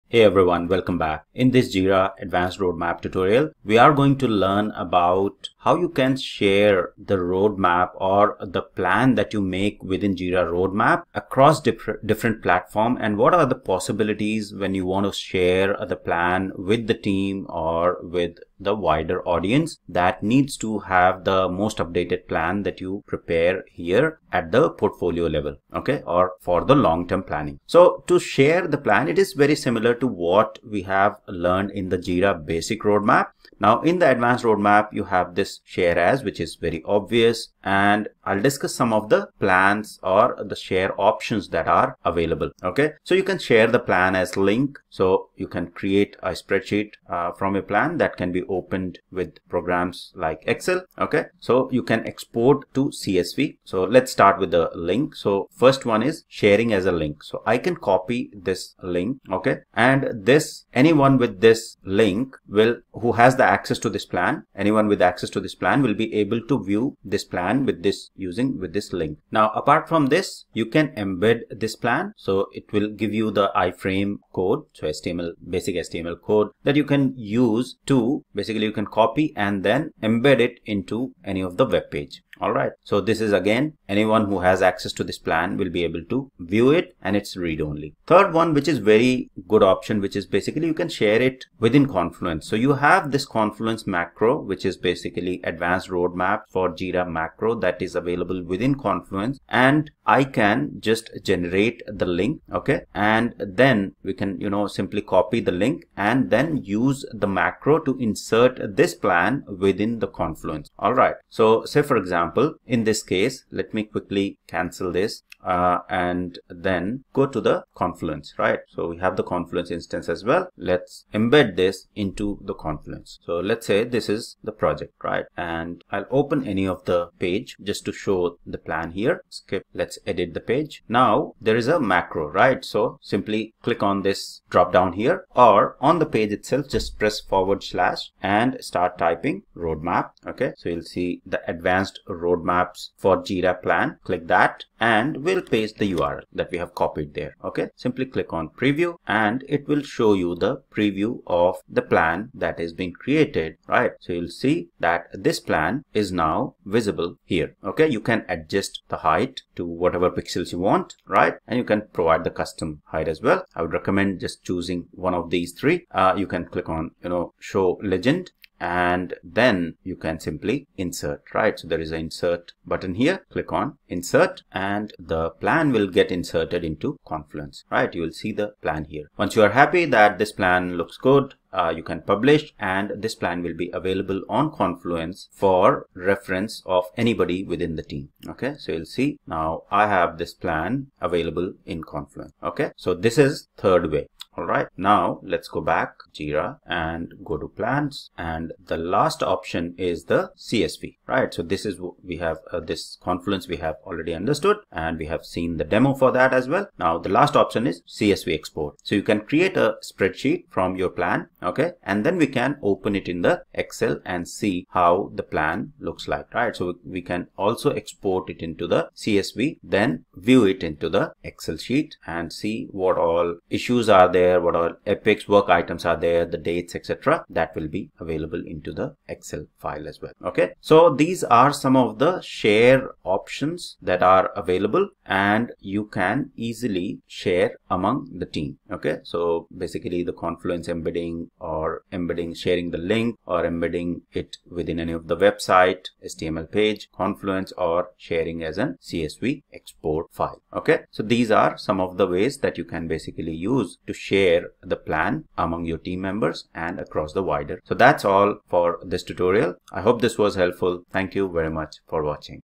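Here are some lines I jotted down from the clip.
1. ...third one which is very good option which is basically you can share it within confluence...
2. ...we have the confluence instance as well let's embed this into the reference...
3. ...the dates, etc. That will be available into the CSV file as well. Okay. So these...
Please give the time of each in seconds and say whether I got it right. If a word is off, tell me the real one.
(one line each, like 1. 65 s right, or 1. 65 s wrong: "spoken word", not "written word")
1. 88 s right
2. 118 s wrong: "confluence", not "reference"
3. 226 s wrong: "Excel", not "CSV".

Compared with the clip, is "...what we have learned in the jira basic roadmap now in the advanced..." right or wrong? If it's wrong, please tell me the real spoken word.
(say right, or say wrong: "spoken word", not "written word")
right.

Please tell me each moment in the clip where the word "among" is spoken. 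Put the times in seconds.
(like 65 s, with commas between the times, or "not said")
237 s, 255 s.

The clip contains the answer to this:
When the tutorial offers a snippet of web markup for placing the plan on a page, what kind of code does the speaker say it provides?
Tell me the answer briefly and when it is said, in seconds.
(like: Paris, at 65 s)
iframe code, at 73 s.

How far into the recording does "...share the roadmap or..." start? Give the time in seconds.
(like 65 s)
6 s.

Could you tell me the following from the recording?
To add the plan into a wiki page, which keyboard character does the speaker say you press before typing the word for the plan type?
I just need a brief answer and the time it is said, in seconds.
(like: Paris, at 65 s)
forward slash, at 137 s.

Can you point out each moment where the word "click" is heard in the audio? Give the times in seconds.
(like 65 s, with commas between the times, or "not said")
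133 s, 144 s, 148 s, 166 s, 173 s.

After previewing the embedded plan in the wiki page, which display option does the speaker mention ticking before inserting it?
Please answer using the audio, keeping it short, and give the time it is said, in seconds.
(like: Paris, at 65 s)
show legend, at 167 s.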